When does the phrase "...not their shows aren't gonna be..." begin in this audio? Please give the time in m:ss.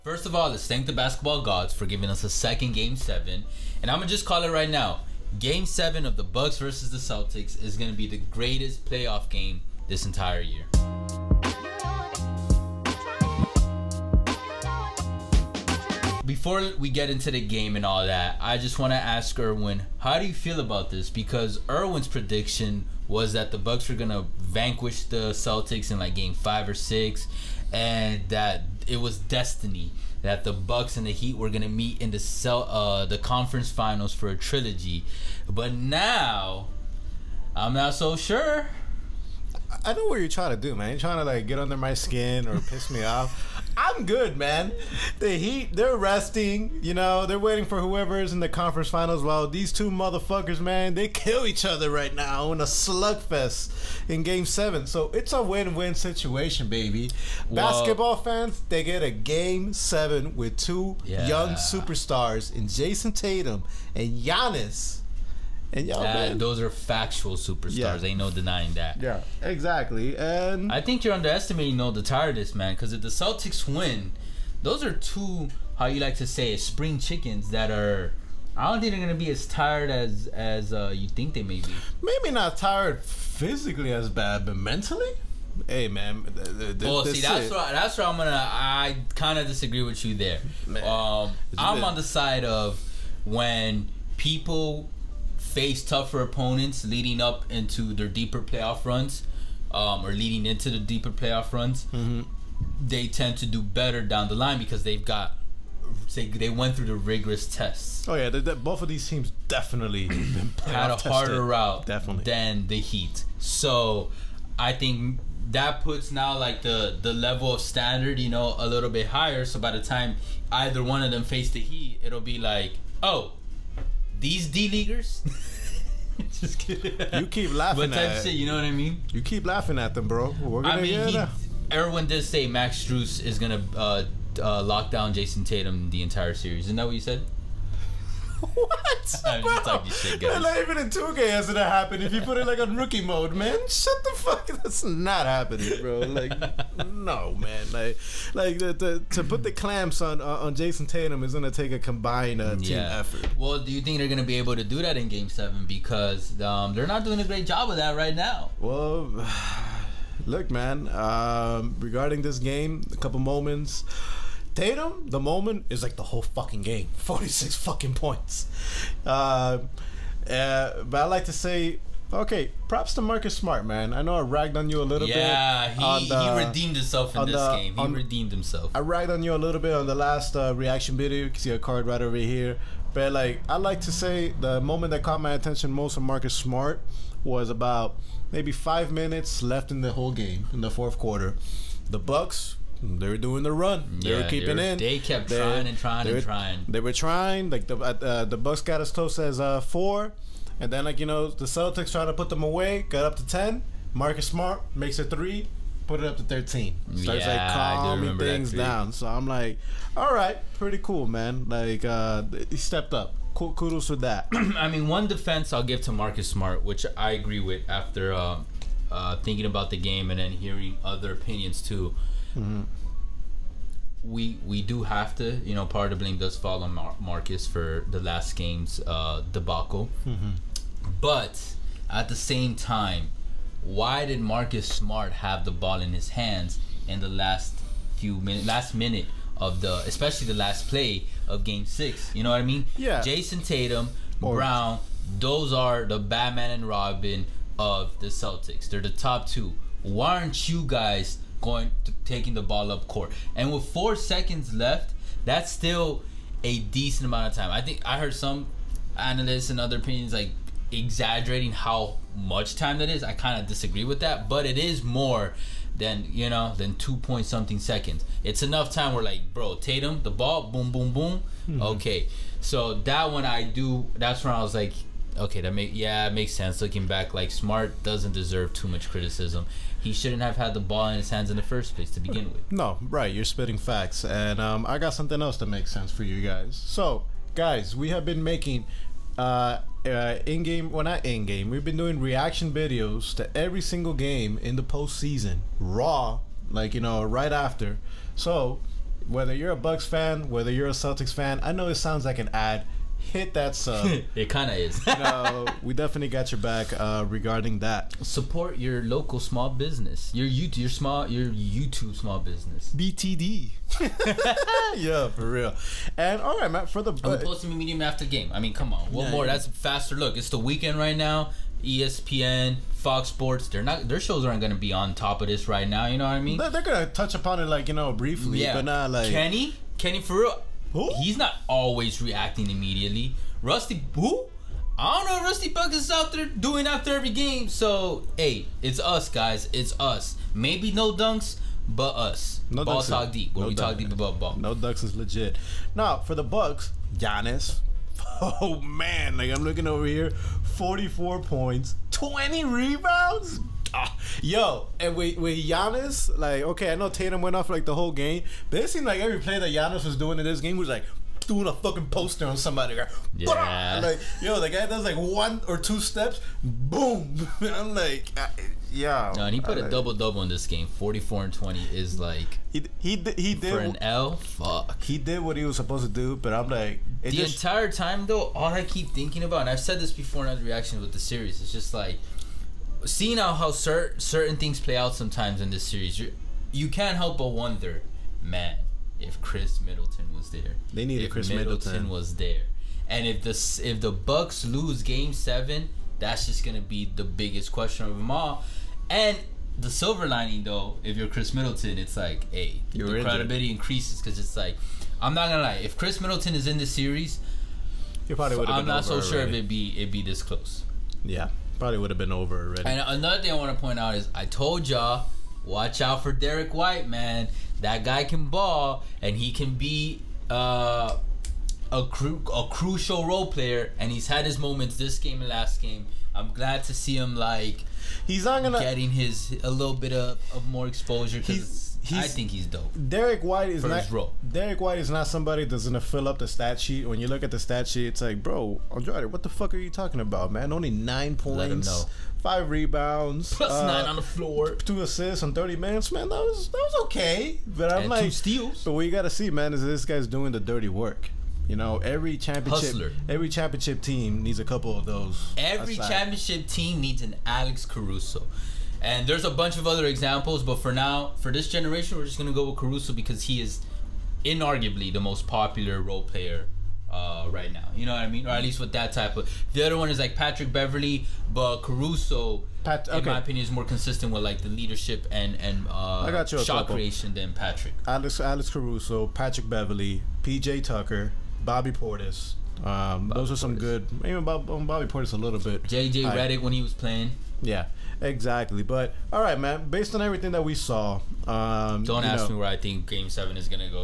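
5:23.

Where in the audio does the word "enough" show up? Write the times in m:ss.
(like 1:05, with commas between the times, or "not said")
4:28.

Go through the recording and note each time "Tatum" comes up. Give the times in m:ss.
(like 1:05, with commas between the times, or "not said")
1:03, 2:15, 2:30, 2:44, 4:03, 4:29, 5:56.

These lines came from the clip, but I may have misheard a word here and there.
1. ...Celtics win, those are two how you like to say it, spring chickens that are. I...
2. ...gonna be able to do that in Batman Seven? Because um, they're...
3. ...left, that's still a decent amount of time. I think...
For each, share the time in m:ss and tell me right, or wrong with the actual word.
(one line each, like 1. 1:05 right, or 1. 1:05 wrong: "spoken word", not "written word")
1. 1:13 right
2. 2:34 wrong: "Game", not "Batman"
3. 4:14 right.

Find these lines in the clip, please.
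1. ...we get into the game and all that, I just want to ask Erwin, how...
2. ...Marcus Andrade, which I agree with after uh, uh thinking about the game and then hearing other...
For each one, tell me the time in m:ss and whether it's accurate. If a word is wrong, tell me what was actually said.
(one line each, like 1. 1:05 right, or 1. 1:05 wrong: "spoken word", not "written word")
1. 0:16 right
2. 3:35 wrong: "Smart", not "Andrade".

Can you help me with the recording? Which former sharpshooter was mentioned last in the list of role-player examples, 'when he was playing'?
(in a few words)
J.J. Redick.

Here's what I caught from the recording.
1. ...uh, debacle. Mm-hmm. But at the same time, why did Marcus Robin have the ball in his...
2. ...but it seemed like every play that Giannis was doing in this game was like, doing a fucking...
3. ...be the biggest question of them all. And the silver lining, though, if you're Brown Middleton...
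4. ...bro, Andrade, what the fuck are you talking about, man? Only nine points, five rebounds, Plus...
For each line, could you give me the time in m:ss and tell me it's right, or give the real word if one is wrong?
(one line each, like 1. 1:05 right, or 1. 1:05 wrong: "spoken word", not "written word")
1. 3:48 wrong: "Smart", not "Robin"
2. 5:58 right
3. 6:36 wrong: "Khris", not "Brown"
4. 7:18 right.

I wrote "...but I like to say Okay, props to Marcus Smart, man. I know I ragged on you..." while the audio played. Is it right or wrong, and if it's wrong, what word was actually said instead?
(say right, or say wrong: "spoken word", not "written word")
right.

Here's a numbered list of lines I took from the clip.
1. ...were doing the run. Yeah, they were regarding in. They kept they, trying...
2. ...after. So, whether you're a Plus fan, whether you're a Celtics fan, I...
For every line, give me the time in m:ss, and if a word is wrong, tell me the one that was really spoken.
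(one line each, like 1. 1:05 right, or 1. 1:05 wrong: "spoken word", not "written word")
1. 3:13 wrong: "keeping", not "regarding"
2. 4:57 wrong: "Bucks", not "Plus".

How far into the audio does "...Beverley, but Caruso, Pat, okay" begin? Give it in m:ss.
7:50.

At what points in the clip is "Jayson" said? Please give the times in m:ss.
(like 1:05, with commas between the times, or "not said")
1:02, 2:15, 2:30, 4:03.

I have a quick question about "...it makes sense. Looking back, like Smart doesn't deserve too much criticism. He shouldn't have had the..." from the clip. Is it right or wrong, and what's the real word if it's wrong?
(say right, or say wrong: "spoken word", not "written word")
right.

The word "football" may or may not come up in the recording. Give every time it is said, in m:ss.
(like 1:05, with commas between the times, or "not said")
not said.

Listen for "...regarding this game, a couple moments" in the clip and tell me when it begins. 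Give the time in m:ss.
2:41.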